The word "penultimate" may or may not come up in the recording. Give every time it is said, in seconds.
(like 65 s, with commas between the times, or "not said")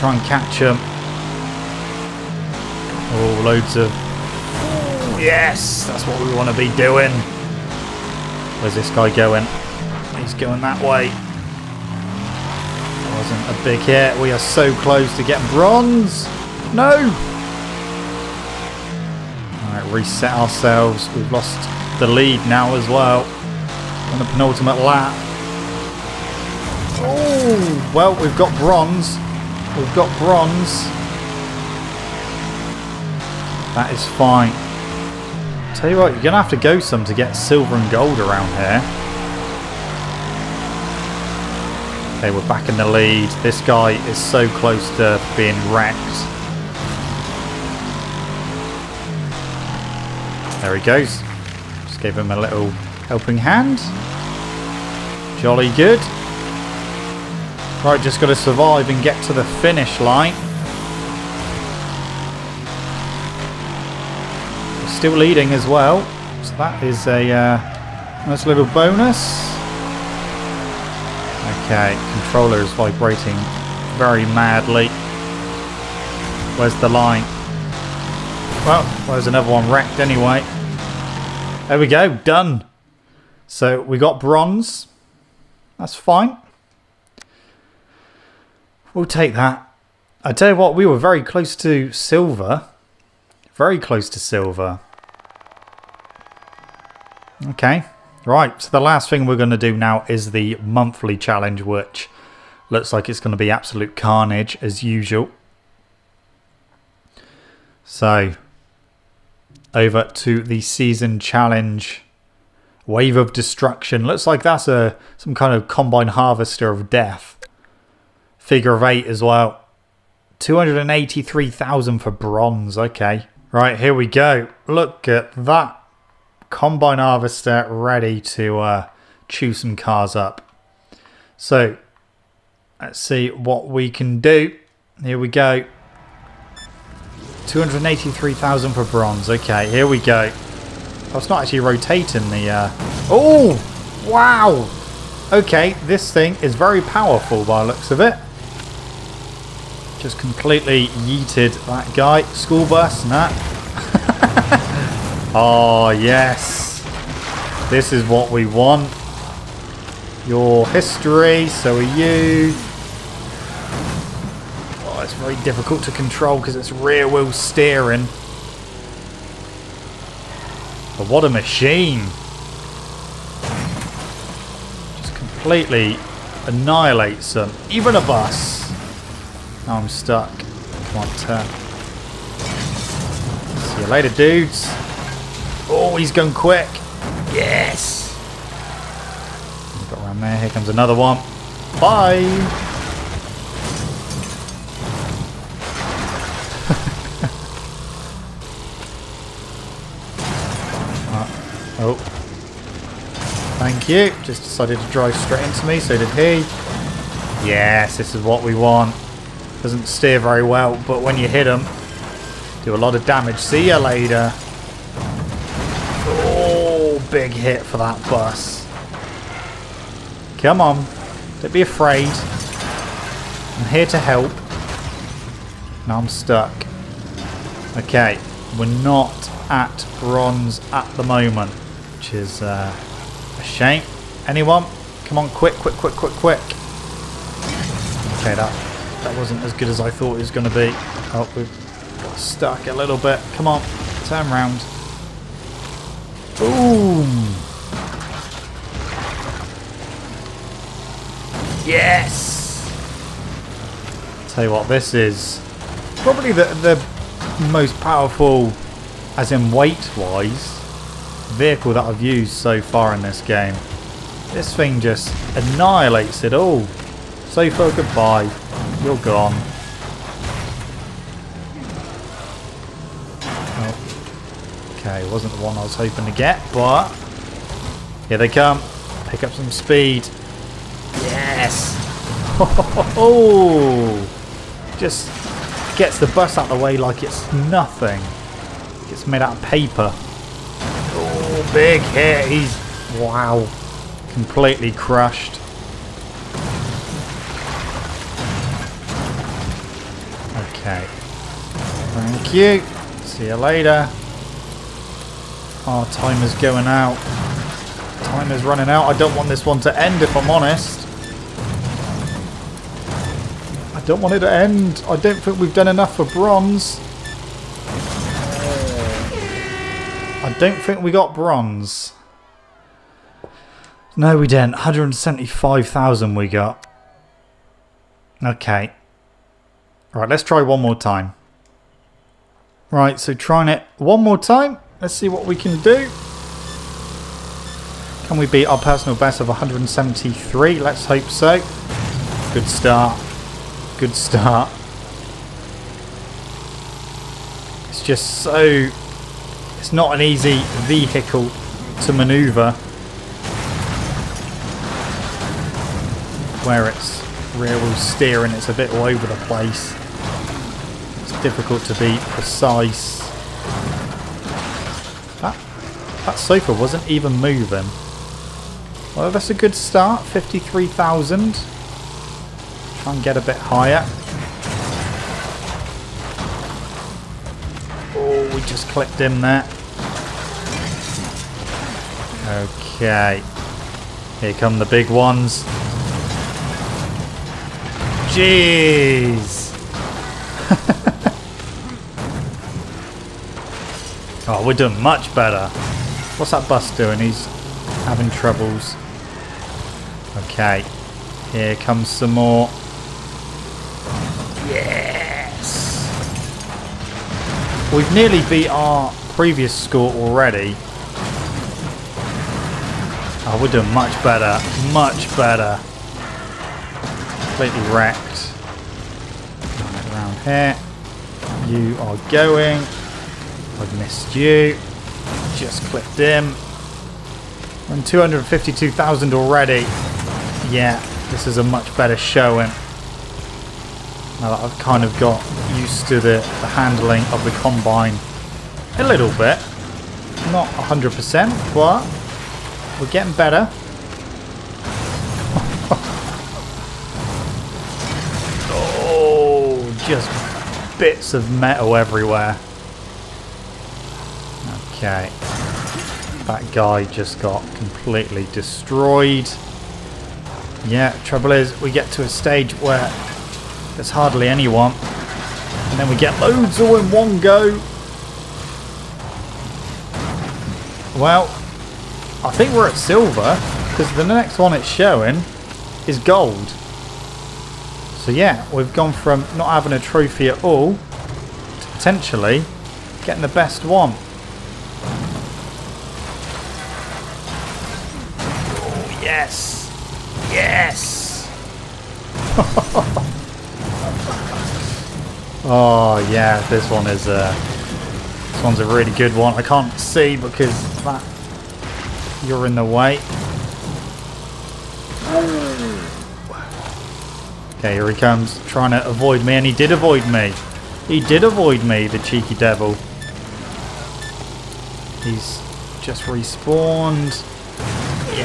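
24 s.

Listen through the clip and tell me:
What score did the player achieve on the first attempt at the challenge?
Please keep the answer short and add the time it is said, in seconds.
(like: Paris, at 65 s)
175,000, at 324 s.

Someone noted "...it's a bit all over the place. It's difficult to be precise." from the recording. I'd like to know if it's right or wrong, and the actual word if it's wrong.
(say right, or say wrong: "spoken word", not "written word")
right.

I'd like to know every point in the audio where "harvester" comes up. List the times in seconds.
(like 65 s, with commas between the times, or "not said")
116 s, 126 s.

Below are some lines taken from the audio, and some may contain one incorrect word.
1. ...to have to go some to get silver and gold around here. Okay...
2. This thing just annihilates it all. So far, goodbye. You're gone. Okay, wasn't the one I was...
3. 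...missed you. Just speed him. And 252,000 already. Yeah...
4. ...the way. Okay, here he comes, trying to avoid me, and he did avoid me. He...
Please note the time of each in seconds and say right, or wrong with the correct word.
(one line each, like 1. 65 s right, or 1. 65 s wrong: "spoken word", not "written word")
1. 36 s right
2. 264 s right
3. 423 s wrong: "clipped", not "speed"
4. 502 s right.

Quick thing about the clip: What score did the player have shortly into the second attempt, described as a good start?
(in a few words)
53,000.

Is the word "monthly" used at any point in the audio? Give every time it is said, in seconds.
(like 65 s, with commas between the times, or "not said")
100 s.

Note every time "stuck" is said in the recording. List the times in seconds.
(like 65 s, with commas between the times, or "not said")
179 s, 226 s, 242 s.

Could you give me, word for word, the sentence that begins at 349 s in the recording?
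It's not an easy vehicle to manoeuvre.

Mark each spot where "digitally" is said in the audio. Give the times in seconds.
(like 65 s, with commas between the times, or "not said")
not said.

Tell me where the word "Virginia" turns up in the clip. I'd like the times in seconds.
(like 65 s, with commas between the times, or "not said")
not said.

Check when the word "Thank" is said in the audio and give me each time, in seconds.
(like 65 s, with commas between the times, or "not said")
203 s, 301 s.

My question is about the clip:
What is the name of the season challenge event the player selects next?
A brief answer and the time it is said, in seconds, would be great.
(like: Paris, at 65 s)
Wave of Destruction, at 112 s.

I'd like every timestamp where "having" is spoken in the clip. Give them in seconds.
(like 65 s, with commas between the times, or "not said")
397 s, 479 s.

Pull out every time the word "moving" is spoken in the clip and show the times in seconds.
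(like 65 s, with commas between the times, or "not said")
367 s.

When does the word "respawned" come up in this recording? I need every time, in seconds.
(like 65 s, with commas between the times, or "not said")
516 s.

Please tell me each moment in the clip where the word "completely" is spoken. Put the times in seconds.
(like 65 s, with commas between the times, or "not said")
150 s, 175 s, 294 s, 417 s, 457 s.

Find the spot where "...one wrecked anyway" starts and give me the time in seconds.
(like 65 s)
79 s.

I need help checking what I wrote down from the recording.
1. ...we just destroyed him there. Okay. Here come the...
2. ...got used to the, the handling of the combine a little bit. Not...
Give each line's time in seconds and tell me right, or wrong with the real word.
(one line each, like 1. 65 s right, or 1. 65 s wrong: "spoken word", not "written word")
1. 378 s wrong: "clipped", not "destroyed"
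2. 435 s right.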